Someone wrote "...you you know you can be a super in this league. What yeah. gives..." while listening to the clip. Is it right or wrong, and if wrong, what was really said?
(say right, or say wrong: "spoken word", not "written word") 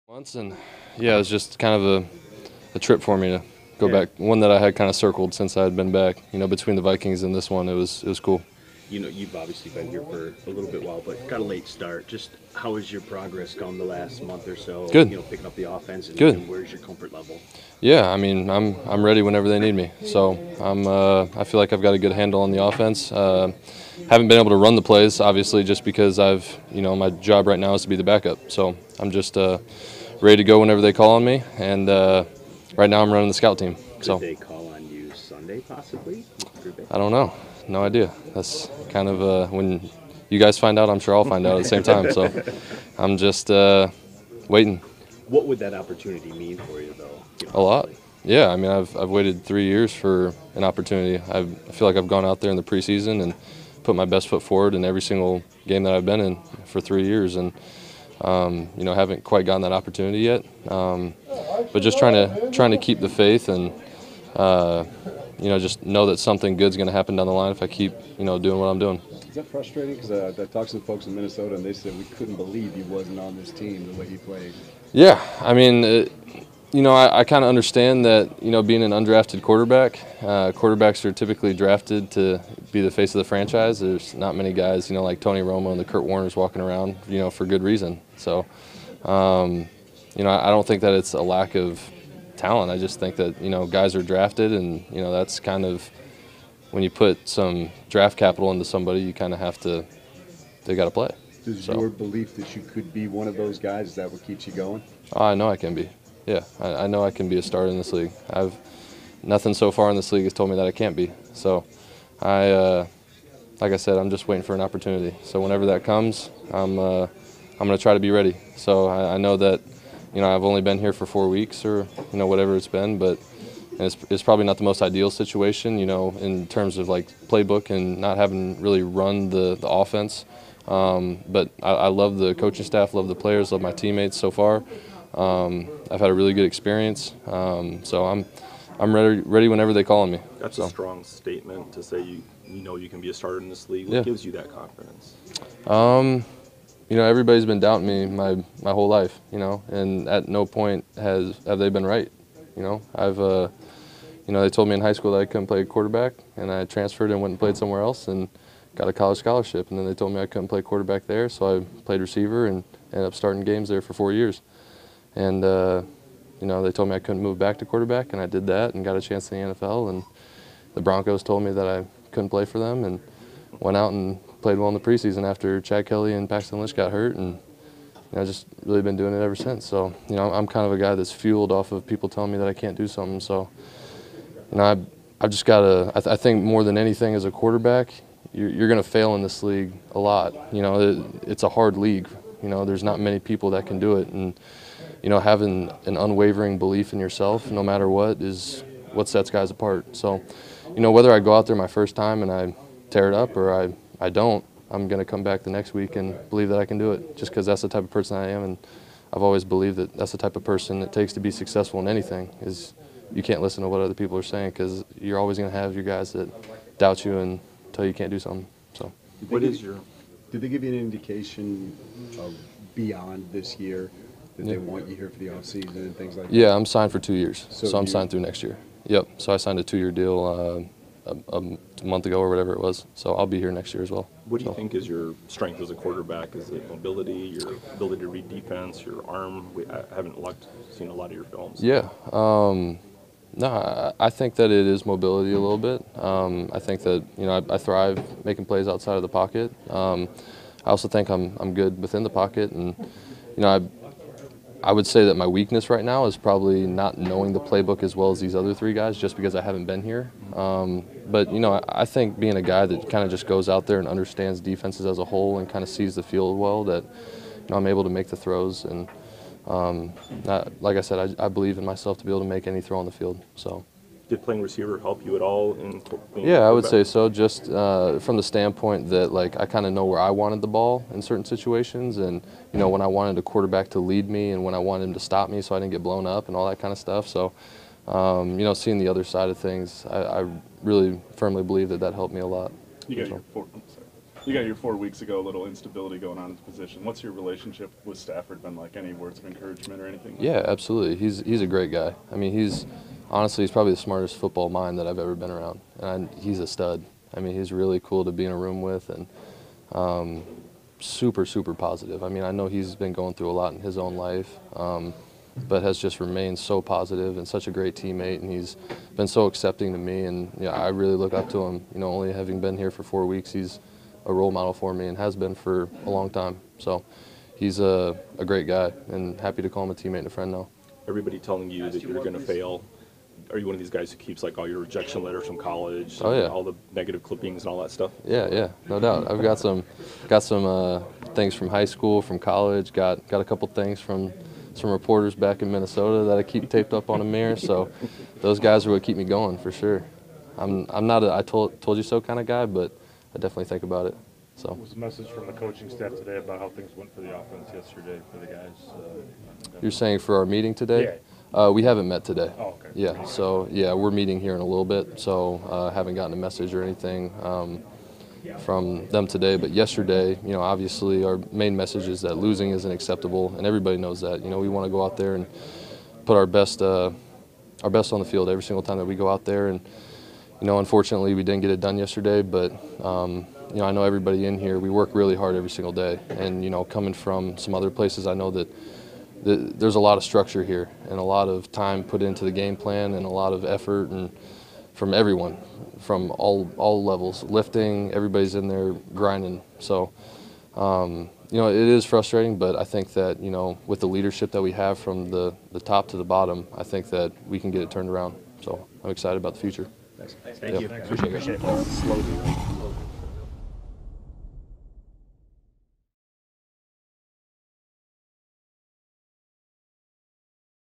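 wrong: "starter", not "super".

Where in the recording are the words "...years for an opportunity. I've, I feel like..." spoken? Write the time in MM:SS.
00:49.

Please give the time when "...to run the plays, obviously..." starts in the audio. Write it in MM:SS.
00:24.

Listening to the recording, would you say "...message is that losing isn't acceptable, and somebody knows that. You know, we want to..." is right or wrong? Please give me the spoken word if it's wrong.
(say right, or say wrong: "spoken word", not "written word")
wrong: "everybody", not "somebody".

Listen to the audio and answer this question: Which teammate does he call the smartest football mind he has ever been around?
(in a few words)
Stafford.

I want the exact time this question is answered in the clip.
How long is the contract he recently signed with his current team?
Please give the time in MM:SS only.
03:49.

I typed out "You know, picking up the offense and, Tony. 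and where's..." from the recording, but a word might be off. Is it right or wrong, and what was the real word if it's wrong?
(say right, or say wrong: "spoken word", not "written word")
wrong: "Good", not "Tony".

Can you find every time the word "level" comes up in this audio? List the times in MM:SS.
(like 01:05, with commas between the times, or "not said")
00:17, 06:36.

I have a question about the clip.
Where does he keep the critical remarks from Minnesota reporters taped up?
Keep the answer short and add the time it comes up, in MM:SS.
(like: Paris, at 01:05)
On a mirror, at 05:46.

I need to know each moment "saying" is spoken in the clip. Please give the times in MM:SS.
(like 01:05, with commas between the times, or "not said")
03:34, 05:59.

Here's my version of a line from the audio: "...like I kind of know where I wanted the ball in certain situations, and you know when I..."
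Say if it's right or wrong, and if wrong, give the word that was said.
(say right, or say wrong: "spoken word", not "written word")
right.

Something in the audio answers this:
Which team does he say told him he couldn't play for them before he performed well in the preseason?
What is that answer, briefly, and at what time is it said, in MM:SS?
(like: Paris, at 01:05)
Broncos, at 02:50.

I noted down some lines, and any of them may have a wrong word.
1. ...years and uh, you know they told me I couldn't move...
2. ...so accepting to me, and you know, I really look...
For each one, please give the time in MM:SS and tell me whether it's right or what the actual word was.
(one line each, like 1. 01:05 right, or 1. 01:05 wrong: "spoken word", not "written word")
1. 02:44 right
2. 05:19 right.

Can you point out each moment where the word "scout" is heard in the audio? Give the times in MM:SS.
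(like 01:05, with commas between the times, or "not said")
00:33.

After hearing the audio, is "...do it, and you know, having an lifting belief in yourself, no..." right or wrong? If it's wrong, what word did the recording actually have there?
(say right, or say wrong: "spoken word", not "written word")
wrong: "unwavering", not "lifting".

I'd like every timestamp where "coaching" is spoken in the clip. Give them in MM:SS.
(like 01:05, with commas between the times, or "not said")
02:12, 05:55.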